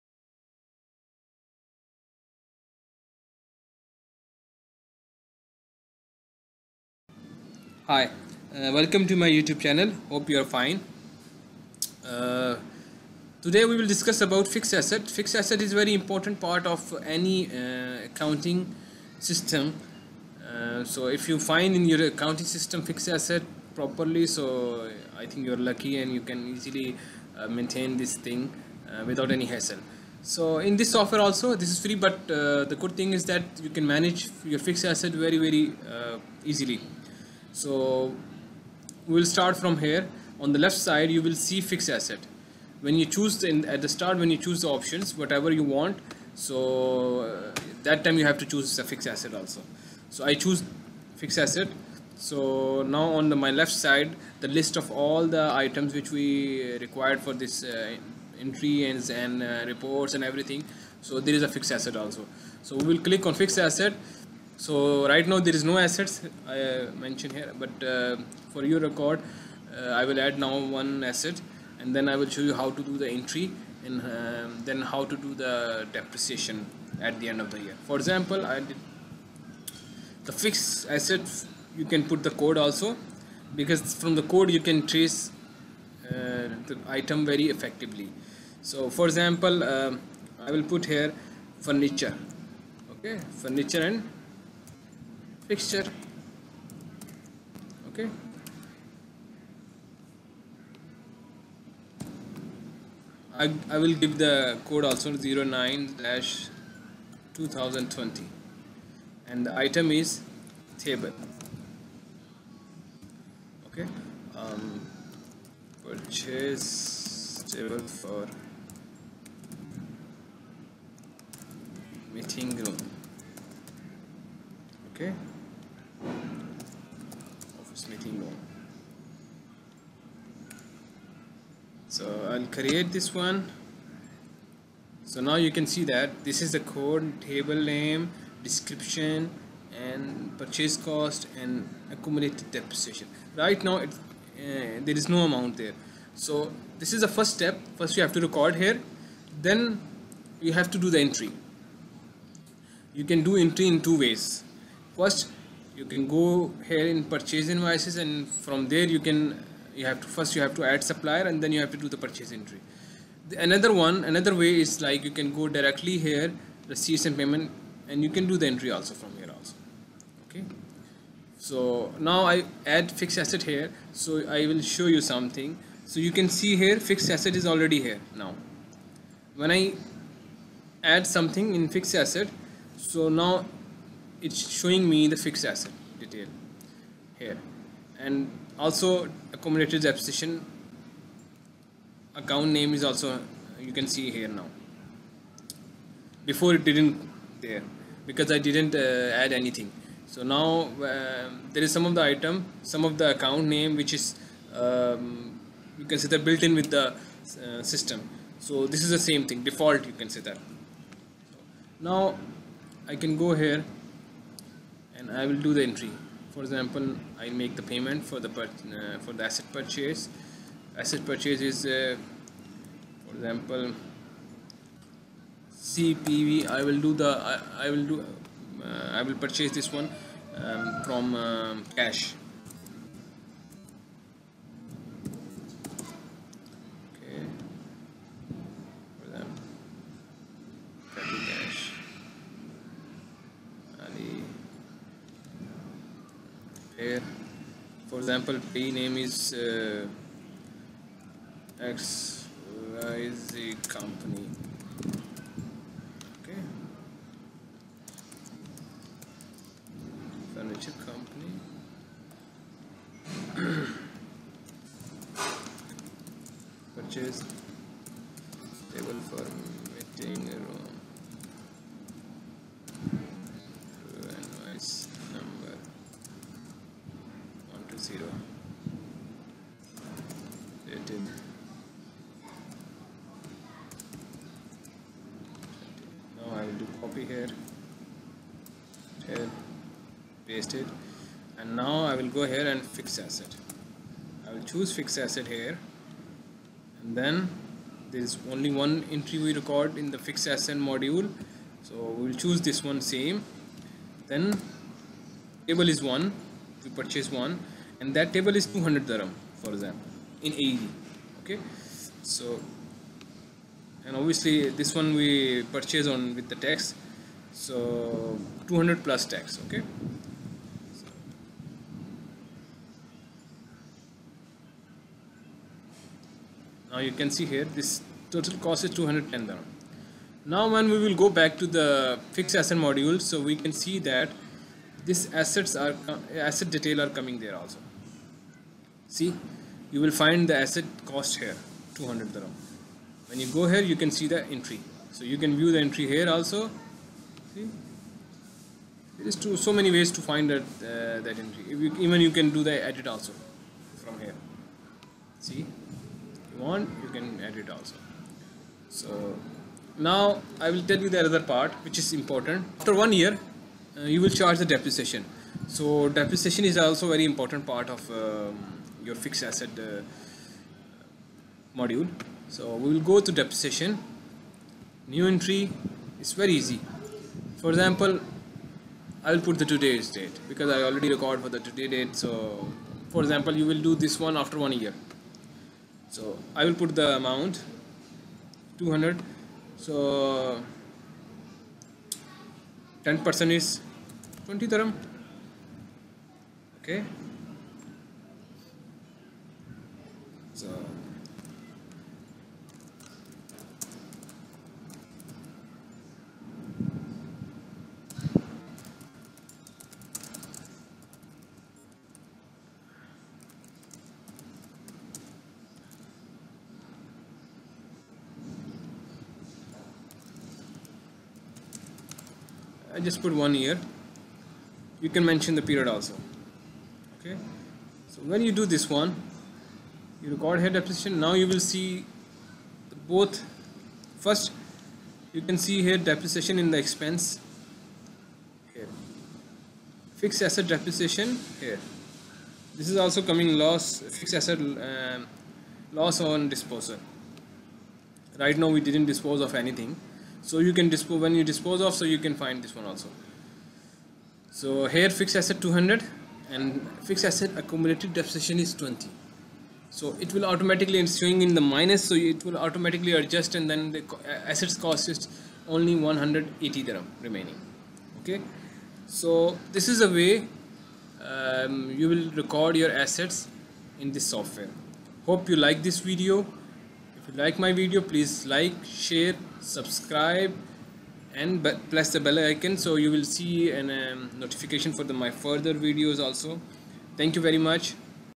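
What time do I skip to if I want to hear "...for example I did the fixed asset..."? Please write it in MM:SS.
01:17.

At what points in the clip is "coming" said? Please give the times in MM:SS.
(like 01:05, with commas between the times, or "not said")
05:37, 07:23.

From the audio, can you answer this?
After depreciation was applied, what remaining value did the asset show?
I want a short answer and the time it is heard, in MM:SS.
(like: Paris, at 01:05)
180 dirham, at 07:45.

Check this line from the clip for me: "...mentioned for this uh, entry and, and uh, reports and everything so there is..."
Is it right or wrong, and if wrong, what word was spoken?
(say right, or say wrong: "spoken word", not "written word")
wrong: "required", not "mentioned".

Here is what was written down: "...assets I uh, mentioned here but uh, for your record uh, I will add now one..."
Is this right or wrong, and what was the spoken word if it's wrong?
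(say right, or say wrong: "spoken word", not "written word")
right.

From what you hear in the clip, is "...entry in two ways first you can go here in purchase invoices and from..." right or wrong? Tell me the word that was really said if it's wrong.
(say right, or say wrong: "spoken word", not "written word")
right.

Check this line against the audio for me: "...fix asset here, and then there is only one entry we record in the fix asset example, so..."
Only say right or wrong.
wrong.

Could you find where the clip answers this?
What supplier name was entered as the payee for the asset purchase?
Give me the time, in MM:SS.
04:20.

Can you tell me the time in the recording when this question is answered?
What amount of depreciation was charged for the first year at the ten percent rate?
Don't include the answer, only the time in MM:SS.
06:34.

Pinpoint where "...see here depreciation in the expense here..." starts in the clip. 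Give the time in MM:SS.
07:15.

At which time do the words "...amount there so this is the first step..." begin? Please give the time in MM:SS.
02:25.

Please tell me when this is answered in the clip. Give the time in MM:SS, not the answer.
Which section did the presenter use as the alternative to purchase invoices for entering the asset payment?
02:46.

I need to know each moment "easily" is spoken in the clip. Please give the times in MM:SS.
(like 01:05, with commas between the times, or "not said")
00:26, 00:36.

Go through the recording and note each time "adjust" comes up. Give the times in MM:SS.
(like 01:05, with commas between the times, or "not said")
07:42.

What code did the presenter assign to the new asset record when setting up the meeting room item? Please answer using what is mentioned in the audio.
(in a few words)
09-2020.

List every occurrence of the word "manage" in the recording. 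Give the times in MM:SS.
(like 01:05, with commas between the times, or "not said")
00:33.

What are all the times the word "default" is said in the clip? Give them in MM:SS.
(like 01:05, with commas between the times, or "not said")
03:29.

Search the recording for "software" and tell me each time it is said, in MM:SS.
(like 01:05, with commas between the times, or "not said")
00:30, 07:54.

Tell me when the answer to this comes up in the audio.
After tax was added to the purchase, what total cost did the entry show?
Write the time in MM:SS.
05:28.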